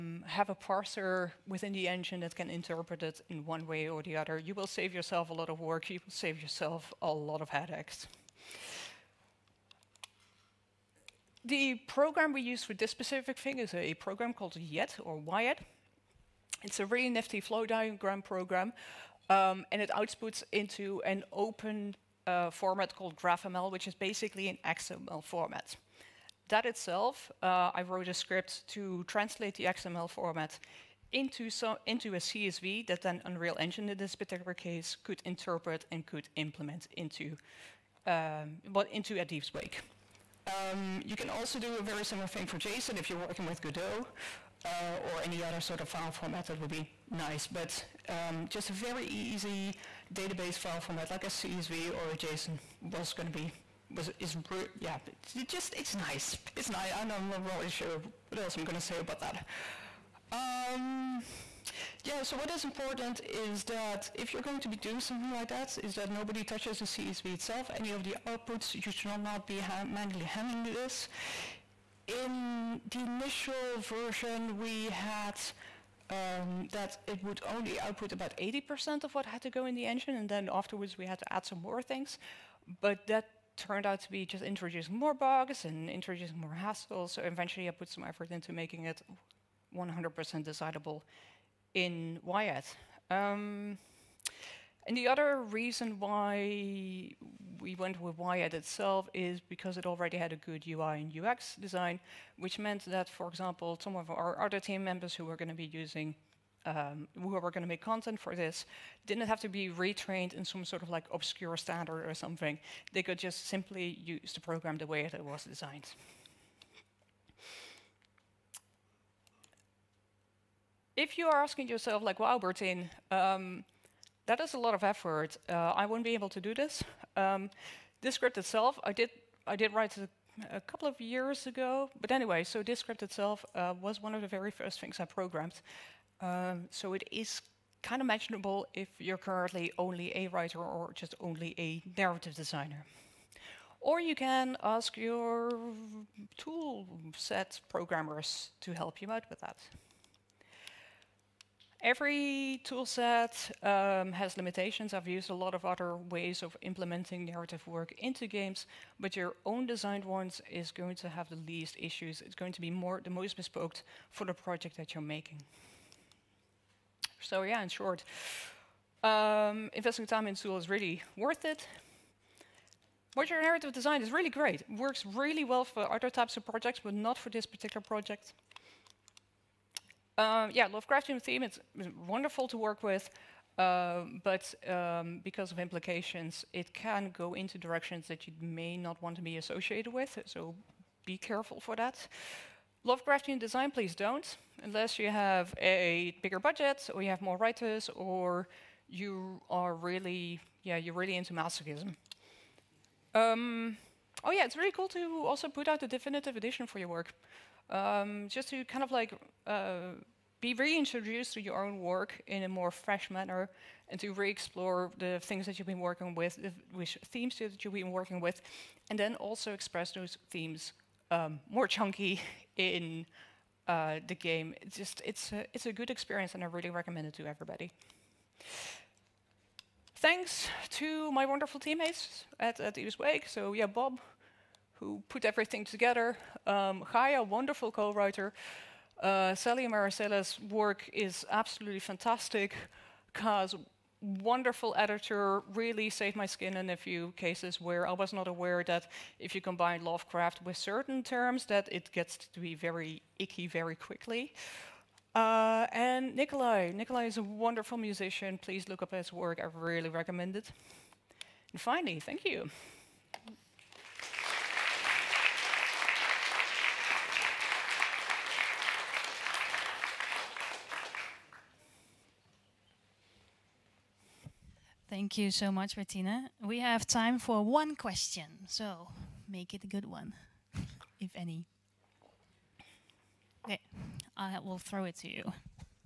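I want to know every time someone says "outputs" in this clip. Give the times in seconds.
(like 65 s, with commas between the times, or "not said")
19 s, 68 s, 77 s.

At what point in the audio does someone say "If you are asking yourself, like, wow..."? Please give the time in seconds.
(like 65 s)
120 s.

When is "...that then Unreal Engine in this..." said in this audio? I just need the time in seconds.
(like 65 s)
32 s.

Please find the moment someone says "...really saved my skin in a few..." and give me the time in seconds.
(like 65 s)
245 s.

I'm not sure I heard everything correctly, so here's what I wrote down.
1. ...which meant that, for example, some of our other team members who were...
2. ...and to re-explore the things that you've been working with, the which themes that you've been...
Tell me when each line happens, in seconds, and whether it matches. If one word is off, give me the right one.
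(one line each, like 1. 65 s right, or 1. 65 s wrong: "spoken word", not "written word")
1. 102 s right
2. 213 s right.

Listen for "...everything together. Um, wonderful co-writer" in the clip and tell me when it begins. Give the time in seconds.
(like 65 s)
235 s.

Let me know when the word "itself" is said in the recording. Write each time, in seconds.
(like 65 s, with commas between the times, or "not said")
26 s, 67 s, 98 s, 128 s, 133 s.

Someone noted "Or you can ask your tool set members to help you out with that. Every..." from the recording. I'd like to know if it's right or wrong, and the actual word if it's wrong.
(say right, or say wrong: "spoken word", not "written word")
wrong: "programmers", not "members".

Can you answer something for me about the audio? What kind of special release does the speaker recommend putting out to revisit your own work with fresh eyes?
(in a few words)
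A definitive edition.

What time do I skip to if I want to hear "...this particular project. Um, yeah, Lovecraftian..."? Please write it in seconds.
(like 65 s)
177 s.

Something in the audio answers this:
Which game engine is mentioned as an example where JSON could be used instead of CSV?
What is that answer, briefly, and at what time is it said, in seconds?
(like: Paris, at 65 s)
Godot, at 43 s.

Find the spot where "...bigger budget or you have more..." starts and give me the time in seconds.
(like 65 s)
196 s.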